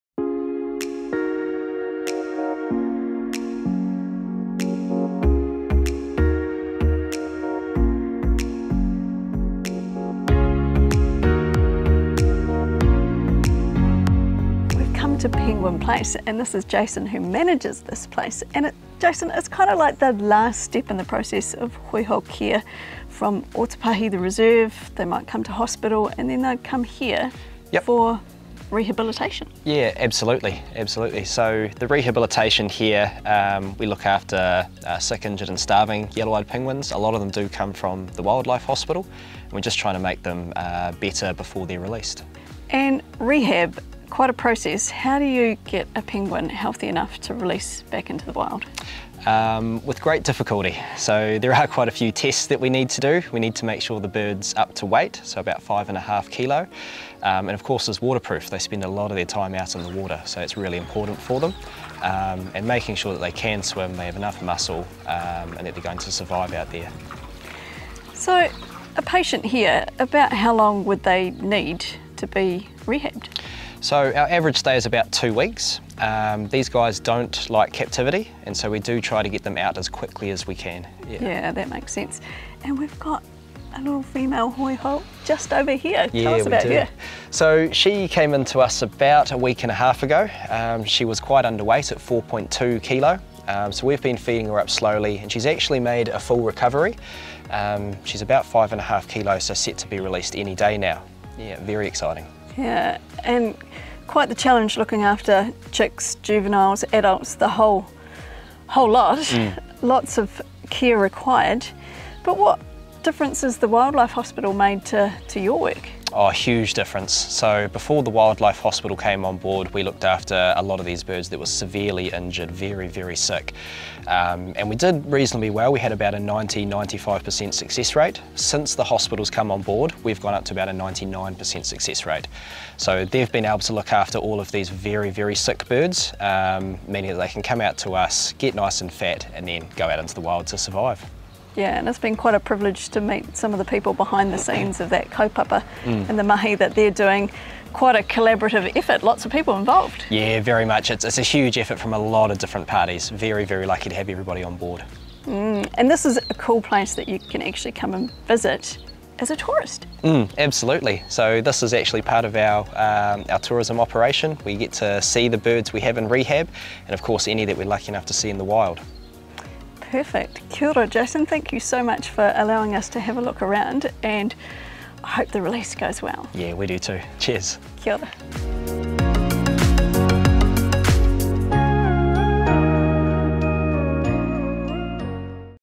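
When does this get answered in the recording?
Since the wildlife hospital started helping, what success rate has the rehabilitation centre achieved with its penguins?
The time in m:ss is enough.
2:10.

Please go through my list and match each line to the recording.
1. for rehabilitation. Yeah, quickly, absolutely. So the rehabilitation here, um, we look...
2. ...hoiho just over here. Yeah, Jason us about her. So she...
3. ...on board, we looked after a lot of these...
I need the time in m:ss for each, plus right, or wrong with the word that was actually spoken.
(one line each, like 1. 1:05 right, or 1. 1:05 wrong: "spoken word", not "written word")
1. 0:27 wrong: "absolutely", not "quickly"
2. 1:24 wrong: "Tell", not "Jason"
3. 1:59 right.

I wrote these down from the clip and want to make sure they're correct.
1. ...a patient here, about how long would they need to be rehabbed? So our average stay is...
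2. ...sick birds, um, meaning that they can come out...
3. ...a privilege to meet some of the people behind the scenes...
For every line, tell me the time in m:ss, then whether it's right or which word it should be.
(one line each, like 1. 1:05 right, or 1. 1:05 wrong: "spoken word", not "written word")
1. 1:08 right
2. 2:15 right
3. 2:22 right.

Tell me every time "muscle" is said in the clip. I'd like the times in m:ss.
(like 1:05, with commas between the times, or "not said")
1:04.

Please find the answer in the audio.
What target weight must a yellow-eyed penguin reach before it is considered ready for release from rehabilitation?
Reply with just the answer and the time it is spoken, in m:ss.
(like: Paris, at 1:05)
5.5 kilos, at 0:55.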